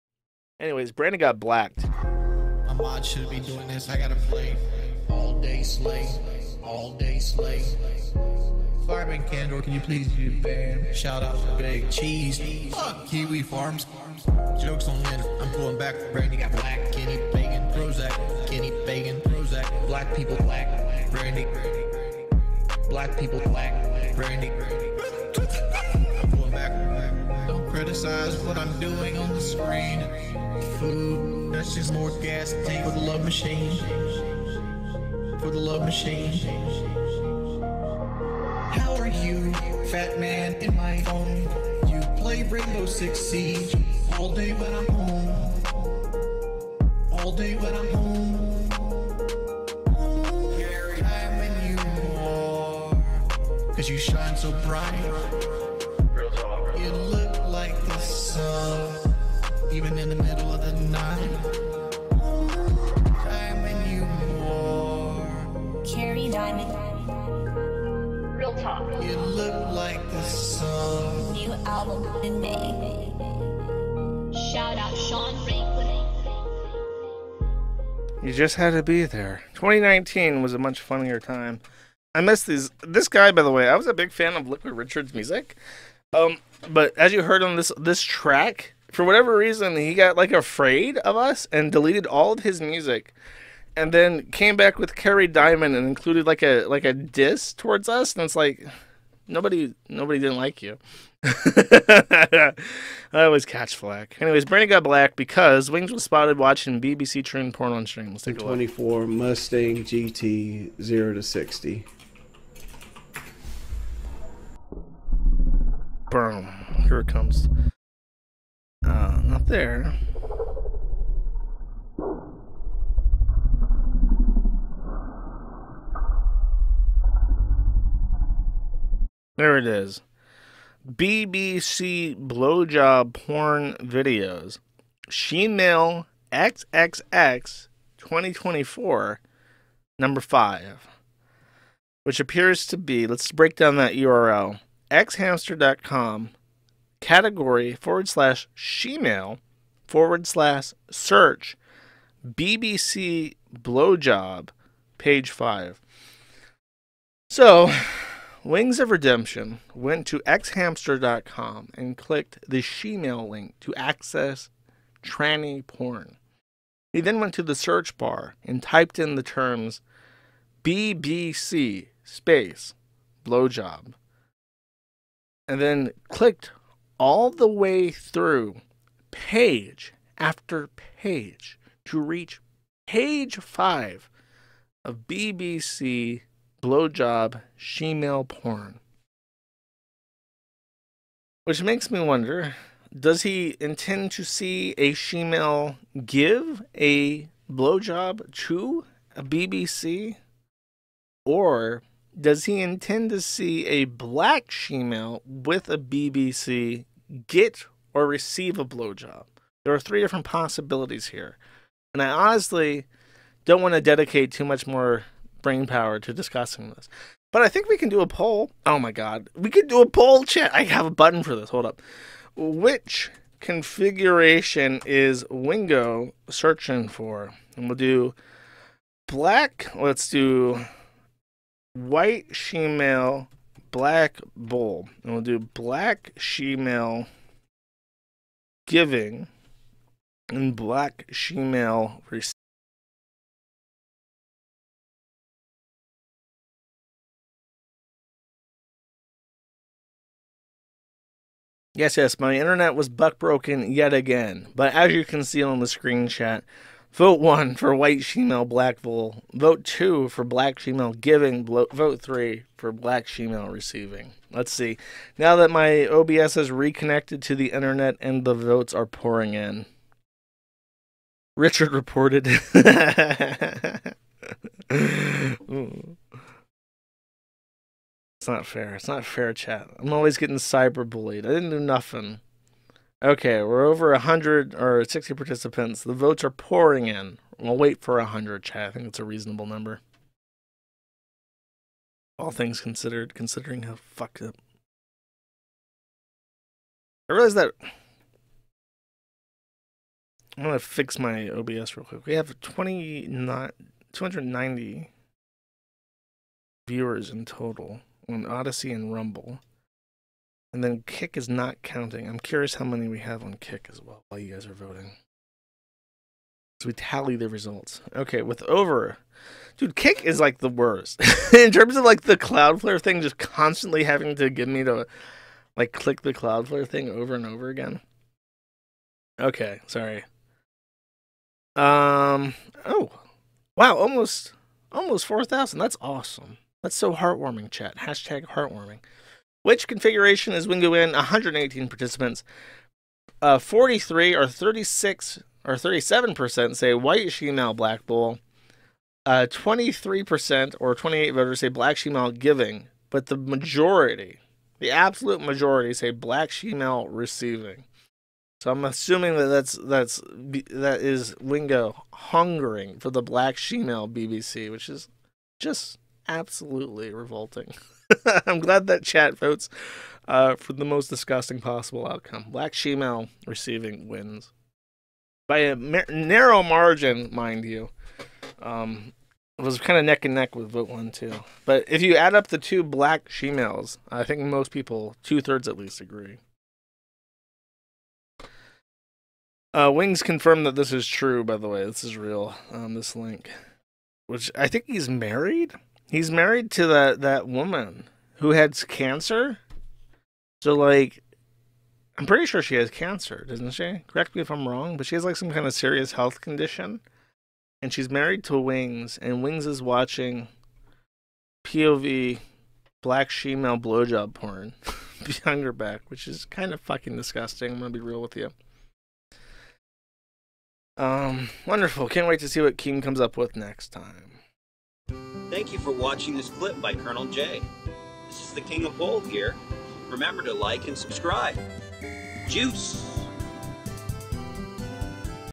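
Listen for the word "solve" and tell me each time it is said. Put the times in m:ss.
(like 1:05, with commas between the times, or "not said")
not said.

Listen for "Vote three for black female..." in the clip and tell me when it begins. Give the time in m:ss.
4:21.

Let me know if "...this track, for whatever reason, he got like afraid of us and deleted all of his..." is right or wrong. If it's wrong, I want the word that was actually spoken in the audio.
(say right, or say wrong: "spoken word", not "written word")
right.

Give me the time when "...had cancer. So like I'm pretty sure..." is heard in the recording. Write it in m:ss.
6:38.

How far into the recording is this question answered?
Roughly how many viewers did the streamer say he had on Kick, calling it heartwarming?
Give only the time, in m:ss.
5:34.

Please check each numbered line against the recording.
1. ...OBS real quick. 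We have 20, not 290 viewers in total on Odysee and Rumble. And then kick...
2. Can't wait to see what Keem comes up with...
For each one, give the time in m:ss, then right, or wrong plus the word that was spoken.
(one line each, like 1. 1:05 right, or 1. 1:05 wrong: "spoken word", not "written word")
1. 5:01 right
2. 7:01 right.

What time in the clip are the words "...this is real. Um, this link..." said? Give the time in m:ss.
6:31.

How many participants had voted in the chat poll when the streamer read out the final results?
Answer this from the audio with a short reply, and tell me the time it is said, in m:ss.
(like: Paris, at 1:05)
118, at 5:40.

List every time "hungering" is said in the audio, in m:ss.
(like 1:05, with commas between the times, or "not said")
6:01.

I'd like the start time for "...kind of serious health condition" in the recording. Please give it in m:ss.
6:45.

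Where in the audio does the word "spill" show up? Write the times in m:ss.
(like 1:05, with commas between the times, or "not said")
not said.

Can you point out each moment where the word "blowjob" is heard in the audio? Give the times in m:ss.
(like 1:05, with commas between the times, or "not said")
2:12, 2:33, 2:53, 3:06, 3:17, 3:28, 6:53.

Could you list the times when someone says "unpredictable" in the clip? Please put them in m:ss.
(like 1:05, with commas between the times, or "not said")
not said.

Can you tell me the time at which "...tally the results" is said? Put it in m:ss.
5:16.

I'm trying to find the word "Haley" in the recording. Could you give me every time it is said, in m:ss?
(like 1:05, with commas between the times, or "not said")
not said.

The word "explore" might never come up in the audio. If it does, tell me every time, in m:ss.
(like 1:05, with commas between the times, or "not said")
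not said.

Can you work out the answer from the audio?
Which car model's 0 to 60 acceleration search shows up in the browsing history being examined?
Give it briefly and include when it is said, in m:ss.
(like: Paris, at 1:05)
Mustang GT, at 1:49.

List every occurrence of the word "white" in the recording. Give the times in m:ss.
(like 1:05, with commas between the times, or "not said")
3:51, 4:17, 5:46.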